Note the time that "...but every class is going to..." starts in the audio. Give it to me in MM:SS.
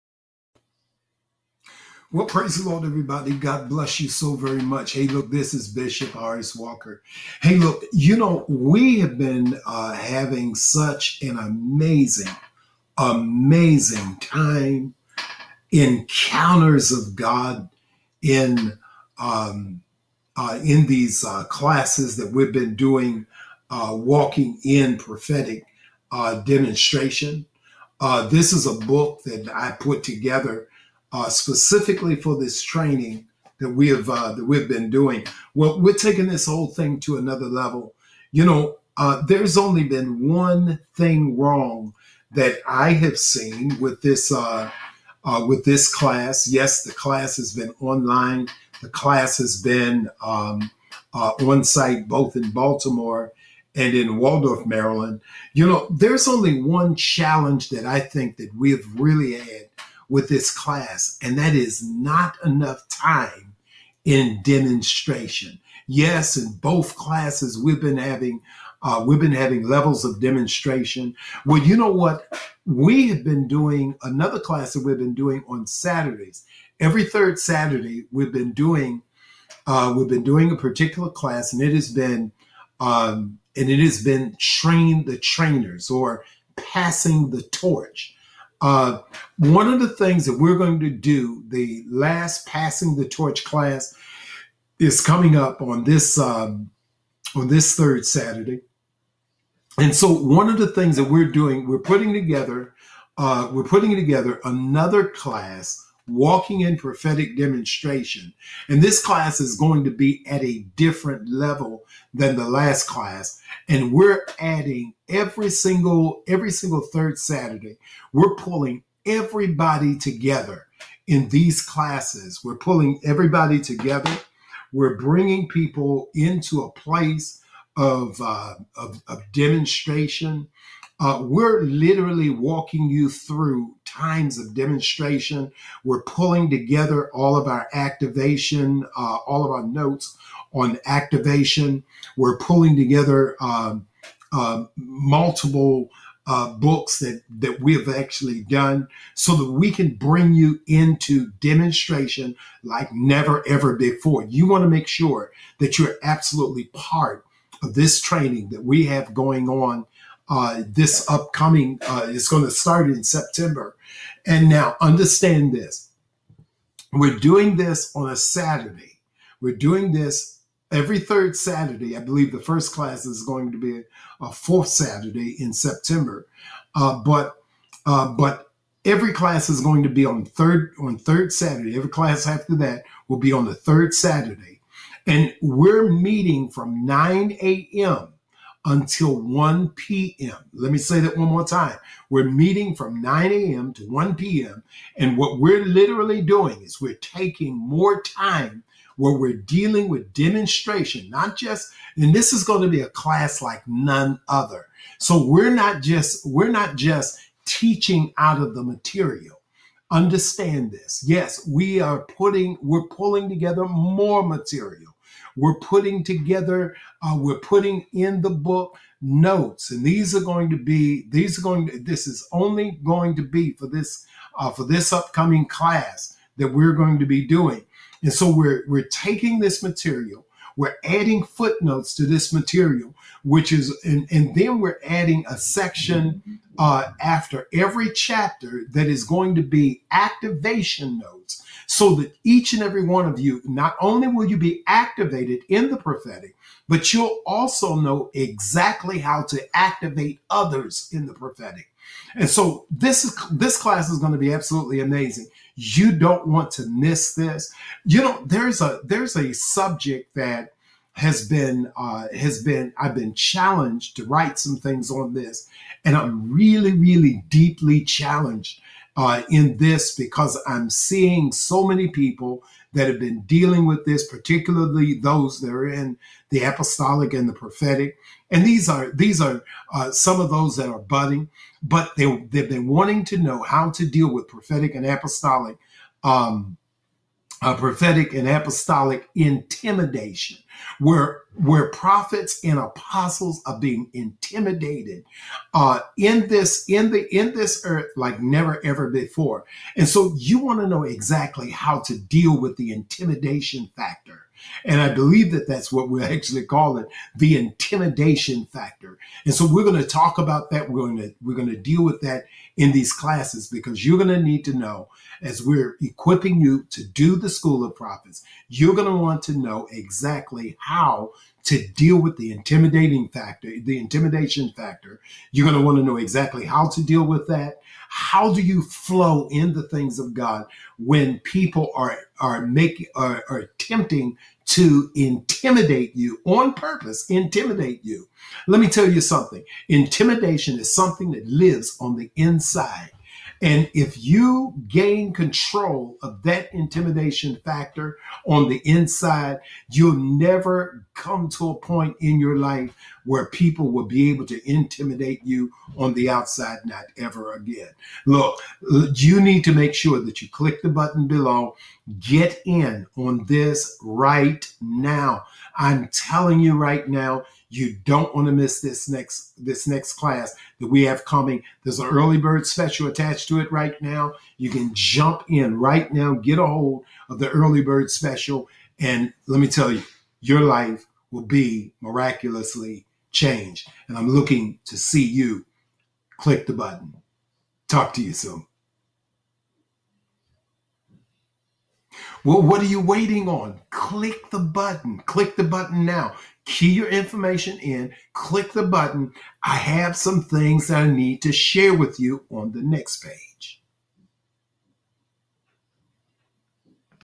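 02:58.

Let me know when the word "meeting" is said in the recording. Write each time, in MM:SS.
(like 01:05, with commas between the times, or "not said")
03:05, 03:12.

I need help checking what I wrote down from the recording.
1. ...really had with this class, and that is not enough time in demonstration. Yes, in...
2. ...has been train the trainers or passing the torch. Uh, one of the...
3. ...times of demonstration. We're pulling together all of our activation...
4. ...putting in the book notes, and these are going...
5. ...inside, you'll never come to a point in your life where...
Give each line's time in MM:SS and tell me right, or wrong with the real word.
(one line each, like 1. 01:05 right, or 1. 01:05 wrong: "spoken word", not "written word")
1. 00:58 right
2. 01:23 right
3. 02:13 right
4. 03:37 right
5. 05:48 right.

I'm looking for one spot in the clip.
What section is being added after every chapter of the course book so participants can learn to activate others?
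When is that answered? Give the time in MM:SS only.
03:59.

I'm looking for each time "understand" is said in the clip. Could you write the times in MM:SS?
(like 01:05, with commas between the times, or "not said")
02:44, 03:29.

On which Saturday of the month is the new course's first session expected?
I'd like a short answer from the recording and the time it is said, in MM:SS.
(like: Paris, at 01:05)
Fourth Saturday, at 02:54.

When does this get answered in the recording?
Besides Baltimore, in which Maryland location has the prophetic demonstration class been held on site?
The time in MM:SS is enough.
00:54.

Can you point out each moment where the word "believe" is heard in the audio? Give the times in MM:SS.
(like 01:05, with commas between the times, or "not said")
02:51, 05:04.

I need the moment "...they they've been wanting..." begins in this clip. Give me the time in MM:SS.
04:41.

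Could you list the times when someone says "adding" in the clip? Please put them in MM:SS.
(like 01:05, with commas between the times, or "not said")
01:54, 03:50, 03:54.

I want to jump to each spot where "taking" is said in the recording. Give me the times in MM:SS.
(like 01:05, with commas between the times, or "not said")
00:35, 03:16, 03:48.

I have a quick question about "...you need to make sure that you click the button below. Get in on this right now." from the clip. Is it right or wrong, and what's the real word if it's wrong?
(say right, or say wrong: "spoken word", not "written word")
right.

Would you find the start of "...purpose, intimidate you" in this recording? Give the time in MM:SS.
05:36.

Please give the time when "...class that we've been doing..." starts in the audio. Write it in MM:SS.
01:14.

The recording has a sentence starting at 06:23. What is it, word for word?
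And I'm looking to see you click the button.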